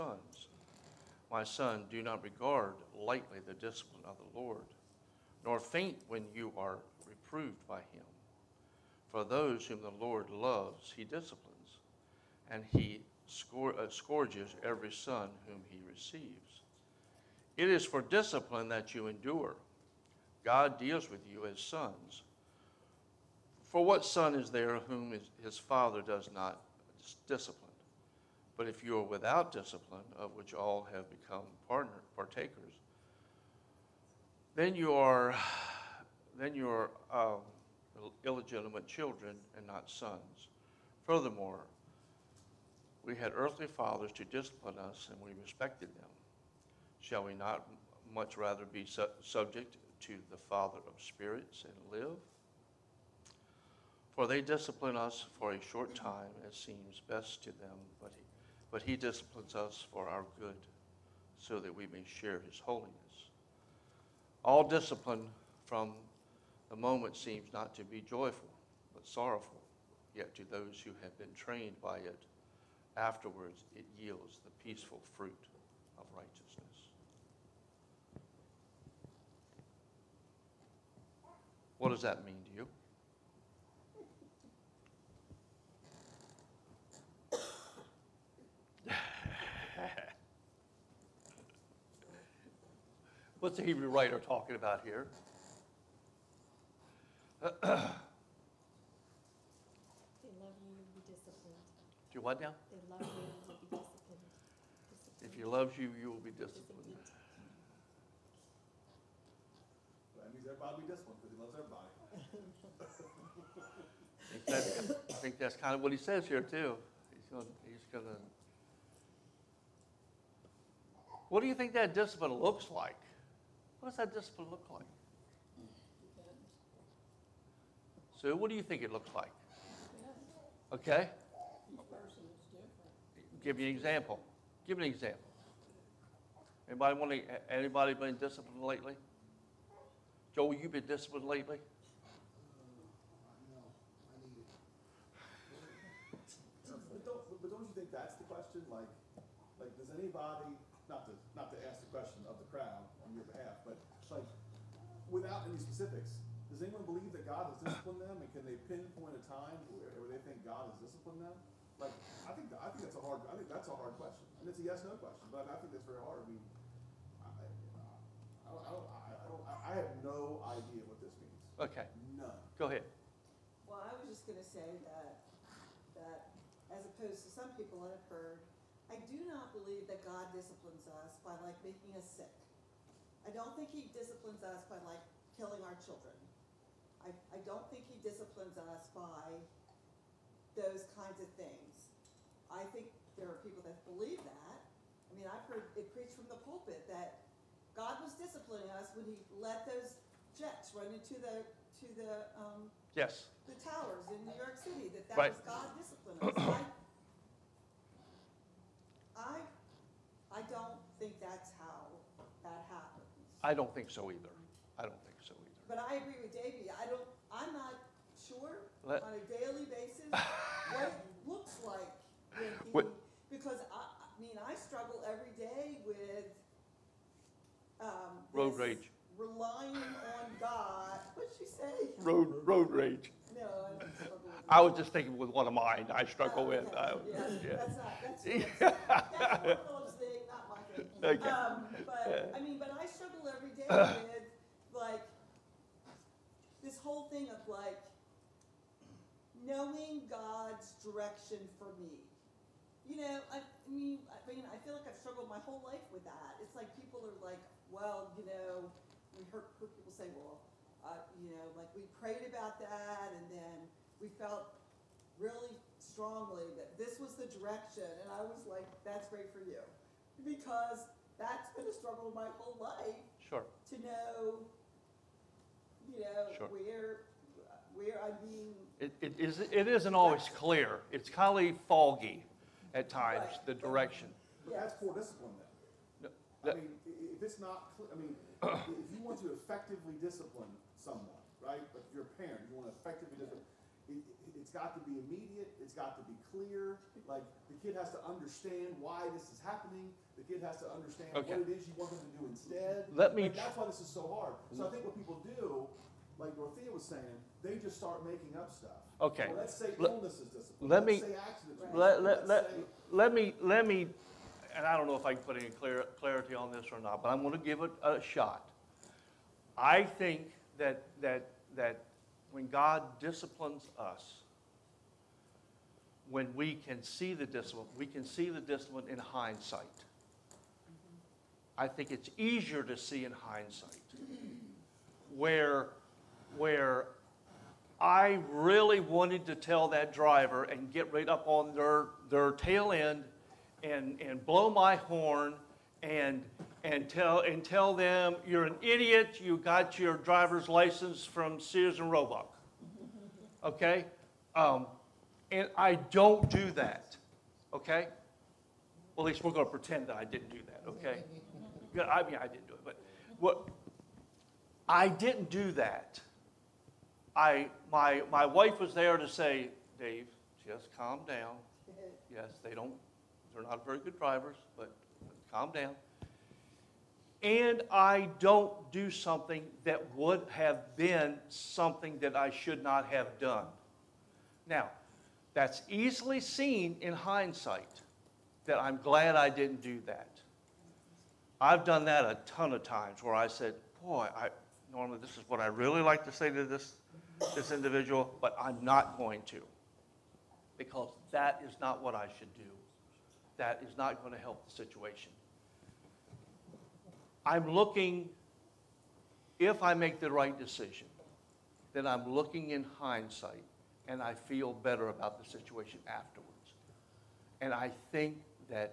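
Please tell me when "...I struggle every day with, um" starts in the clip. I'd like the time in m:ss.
3:44.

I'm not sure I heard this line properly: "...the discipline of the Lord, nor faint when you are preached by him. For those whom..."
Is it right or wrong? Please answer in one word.
wrong.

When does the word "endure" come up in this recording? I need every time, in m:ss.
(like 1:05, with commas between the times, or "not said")
0:19.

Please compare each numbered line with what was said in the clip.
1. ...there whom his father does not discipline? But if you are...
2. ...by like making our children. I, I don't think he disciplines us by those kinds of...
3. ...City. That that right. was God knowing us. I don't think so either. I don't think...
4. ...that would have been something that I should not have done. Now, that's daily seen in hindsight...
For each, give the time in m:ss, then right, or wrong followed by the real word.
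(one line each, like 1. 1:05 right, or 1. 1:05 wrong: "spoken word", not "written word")
1. 0:24 right
2. 3:04 wrong: "killing", not "making"
3. 3:24 wrong: "disciplining", not "knowing"
4. 6:19 wrong: "easily", not "daily".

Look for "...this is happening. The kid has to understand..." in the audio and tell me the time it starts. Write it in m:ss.
4:59.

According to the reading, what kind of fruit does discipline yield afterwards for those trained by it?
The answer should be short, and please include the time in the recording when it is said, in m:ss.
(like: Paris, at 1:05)
peaceful fruit of righteousness, at 1:14.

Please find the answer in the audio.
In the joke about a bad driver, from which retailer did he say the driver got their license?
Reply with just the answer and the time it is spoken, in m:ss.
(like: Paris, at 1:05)
Sears and Roebuck, at 5:51.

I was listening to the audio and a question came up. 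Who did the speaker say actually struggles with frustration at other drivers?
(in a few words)
Philip.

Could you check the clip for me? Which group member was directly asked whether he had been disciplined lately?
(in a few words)
Joel.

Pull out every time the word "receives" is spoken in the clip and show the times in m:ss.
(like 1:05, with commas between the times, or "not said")
0:15.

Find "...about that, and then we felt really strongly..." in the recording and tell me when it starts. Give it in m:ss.
4:22.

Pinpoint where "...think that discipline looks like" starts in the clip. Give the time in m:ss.
2:01.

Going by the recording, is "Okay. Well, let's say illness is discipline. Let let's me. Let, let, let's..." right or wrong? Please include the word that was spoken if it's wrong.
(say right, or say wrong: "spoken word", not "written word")
right.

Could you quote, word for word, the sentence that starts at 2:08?
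so what do you think it looks like?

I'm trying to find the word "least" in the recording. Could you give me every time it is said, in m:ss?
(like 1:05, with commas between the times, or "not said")
5:59.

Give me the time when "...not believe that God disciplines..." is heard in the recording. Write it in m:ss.
2:59.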